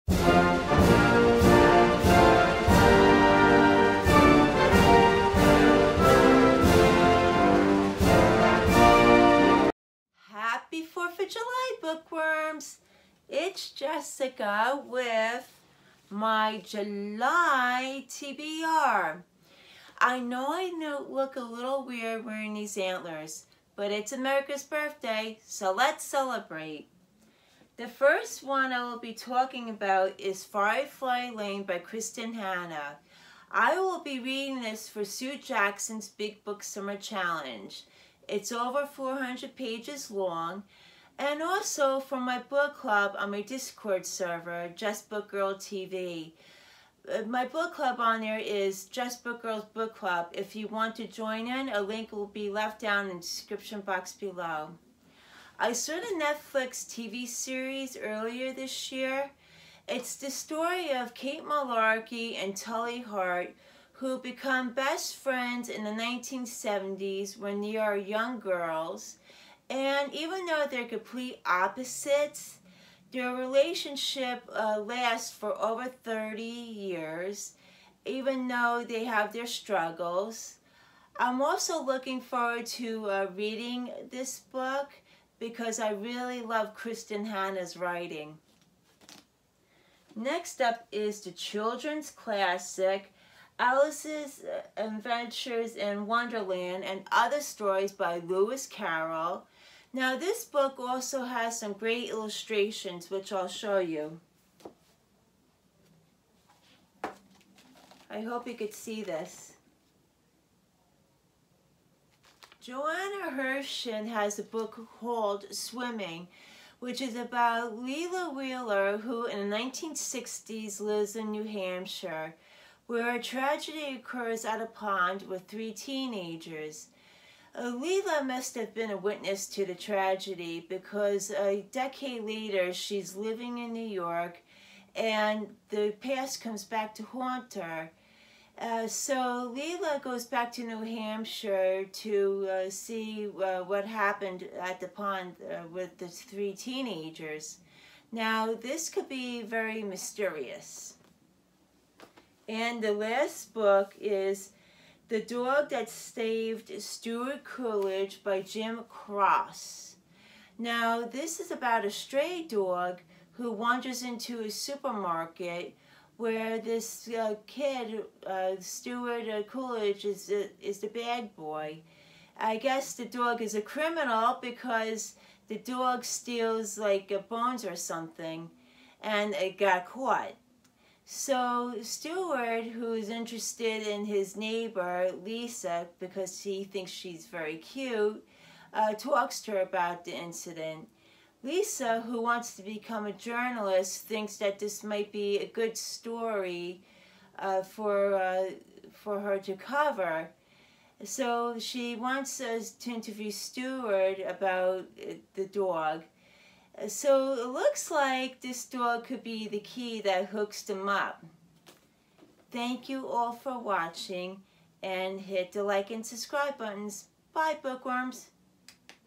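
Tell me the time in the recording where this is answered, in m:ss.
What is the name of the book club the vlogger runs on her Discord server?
0:48.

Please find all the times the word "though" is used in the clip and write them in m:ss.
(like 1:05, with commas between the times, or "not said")
1:10, 1:18.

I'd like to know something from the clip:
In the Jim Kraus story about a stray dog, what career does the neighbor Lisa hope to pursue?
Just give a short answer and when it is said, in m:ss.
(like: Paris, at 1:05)
journalist, at 3:13.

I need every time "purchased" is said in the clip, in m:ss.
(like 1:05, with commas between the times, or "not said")
not said.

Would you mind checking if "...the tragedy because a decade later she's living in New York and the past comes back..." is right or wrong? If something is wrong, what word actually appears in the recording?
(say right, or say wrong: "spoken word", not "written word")
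right.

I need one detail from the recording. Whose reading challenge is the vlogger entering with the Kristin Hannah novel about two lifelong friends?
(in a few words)
Sue Jackson.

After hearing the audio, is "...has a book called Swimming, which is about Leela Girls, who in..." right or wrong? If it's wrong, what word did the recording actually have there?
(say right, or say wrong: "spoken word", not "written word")
wrong: "Wheeler", not "Girls".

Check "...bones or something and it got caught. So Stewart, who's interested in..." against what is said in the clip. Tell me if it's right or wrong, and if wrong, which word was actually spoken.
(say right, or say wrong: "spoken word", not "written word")
right.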